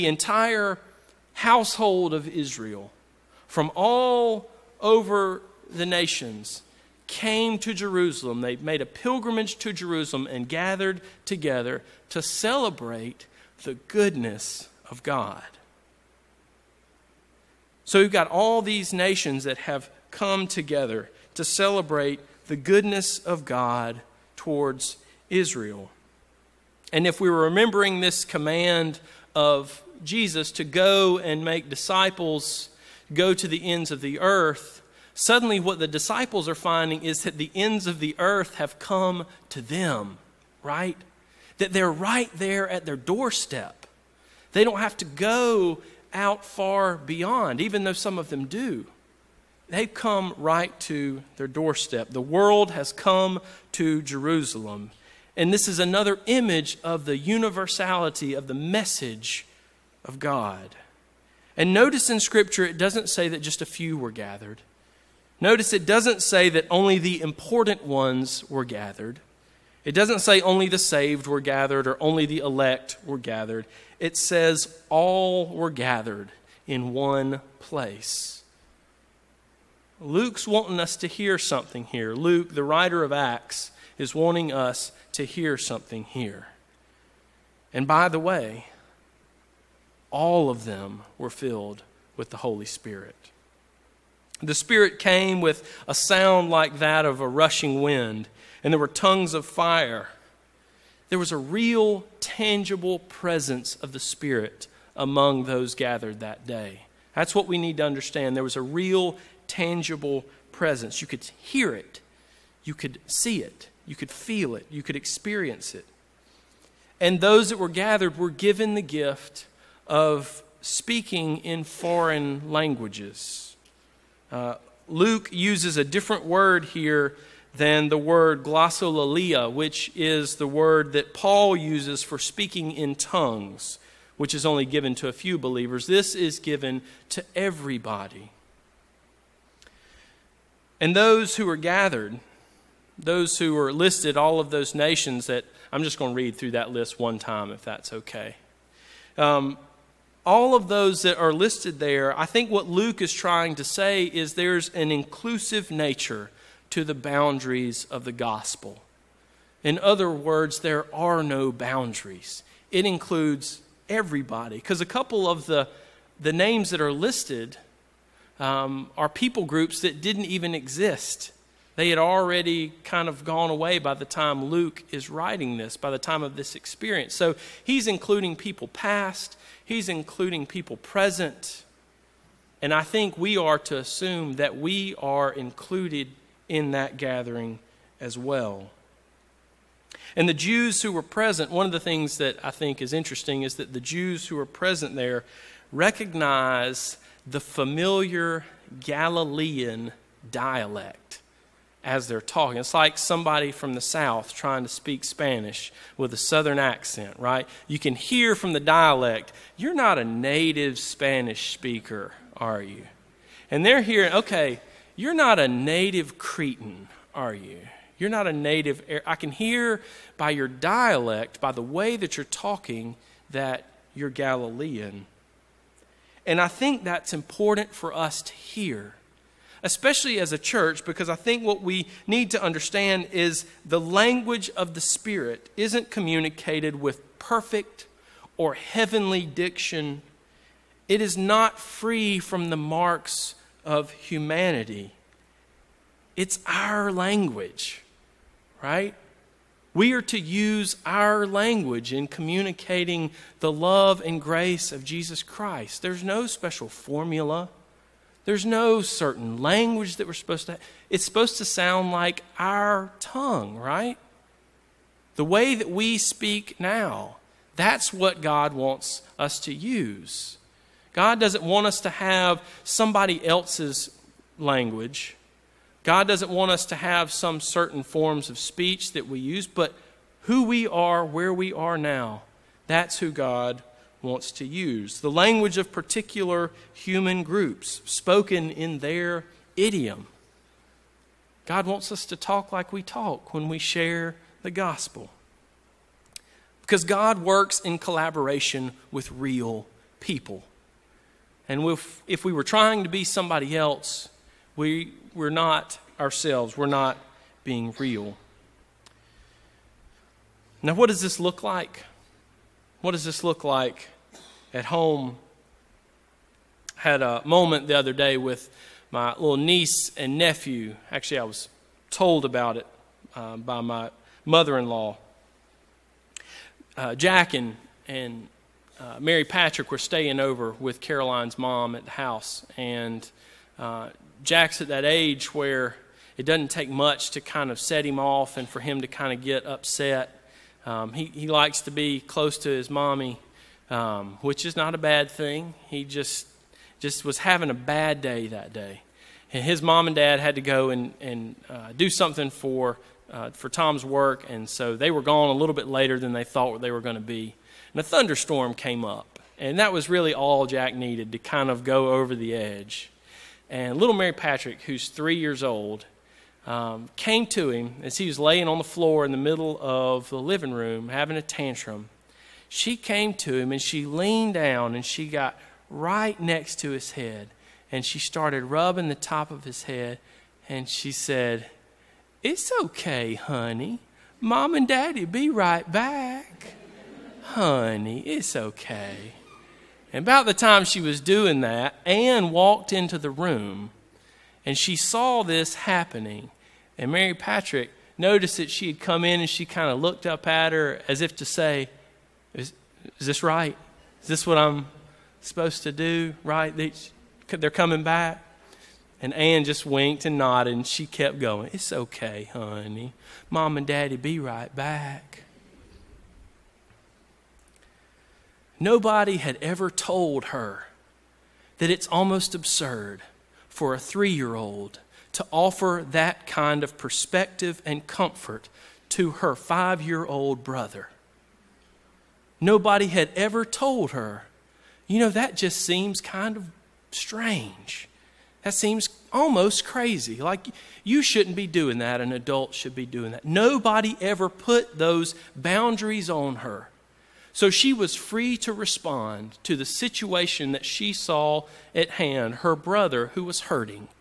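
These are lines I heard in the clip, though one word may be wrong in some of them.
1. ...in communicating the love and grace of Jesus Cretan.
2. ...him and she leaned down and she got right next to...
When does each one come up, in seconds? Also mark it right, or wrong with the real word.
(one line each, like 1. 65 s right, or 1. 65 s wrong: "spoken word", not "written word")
1. 251 s wrong: "Christ", not "Cretan"
2. 373 s right.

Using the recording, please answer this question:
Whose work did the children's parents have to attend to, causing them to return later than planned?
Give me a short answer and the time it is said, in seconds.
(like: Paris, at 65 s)
Tom's, at 353 s.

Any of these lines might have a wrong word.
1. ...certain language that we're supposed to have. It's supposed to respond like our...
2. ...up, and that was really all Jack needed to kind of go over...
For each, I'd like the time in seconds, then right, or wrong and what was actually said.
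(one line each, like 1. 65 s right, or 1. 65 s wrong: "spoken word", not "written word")
1. 258 s wrong: "sound", not "respond"
2. 358 s right.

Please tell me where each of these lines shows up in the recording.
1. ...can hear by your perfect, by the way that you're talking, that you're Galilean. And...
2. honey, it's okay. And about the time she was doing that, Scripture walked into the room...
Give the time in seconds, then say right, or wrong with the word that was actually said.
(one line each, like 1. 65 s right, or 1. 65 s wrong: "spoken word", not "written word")
1. 219 s wrong: "dialect", not "perfect"
2. 387 s wrong: "Anne", not "Scripture".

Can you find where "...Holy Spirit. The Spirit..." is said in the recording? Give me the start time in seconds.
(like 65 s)
92 s.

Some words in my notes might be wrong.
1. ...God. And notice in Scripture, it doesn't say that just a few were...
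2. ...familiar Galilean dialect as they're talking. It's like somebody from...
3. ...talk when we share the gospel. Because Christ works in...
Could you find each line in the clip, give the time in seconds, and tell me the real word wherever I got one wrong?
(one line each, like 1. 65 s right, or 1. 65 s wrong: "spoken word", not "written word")
1. 60 s right
2. 197 s right
3. 292 s wrong: "God", not "Christ".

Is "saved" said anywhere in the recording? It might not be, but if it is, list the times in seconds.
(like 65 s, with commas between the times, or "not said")
70 s.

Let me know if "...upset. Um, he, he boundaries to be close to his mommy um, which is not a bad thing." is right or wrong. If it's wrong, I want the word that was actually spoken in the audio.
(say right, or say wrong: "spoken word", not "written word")
wrong: "likes", not "boundaries".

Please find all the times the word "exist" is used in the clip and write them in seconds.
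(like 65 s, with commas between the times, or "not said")
170 s.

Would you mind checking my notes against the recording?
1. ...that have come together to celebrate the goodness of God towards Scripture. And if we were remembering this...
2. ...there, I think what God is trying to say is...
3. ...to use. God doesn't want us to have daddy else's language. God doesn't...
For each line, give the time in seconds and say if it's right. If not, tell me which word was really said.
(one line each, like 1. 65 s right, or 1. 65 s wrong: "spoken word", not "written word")
1. 19 s wrong: "Israel", not "Scripture"
2. 151 s wrong: "Luke", not "God"
3. 269 s wrong: "somebody", not "daddy".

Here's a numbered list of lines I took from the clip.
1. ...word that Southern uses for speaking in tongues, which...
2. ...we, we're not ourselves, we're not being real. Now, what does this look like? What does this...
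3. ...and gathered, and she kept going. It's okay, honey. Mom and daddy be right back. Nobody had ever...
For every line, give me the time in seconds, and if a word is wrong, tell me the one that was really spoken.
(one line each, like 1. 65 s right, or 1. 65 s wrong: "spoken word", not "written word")
1. 130 s wrong: "Paul", not "Southern"
2. 304 s right
3. 410 s wrong: "nodded", not "gathered".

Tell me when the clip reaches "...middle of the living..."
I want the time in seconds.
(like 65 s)
369 s.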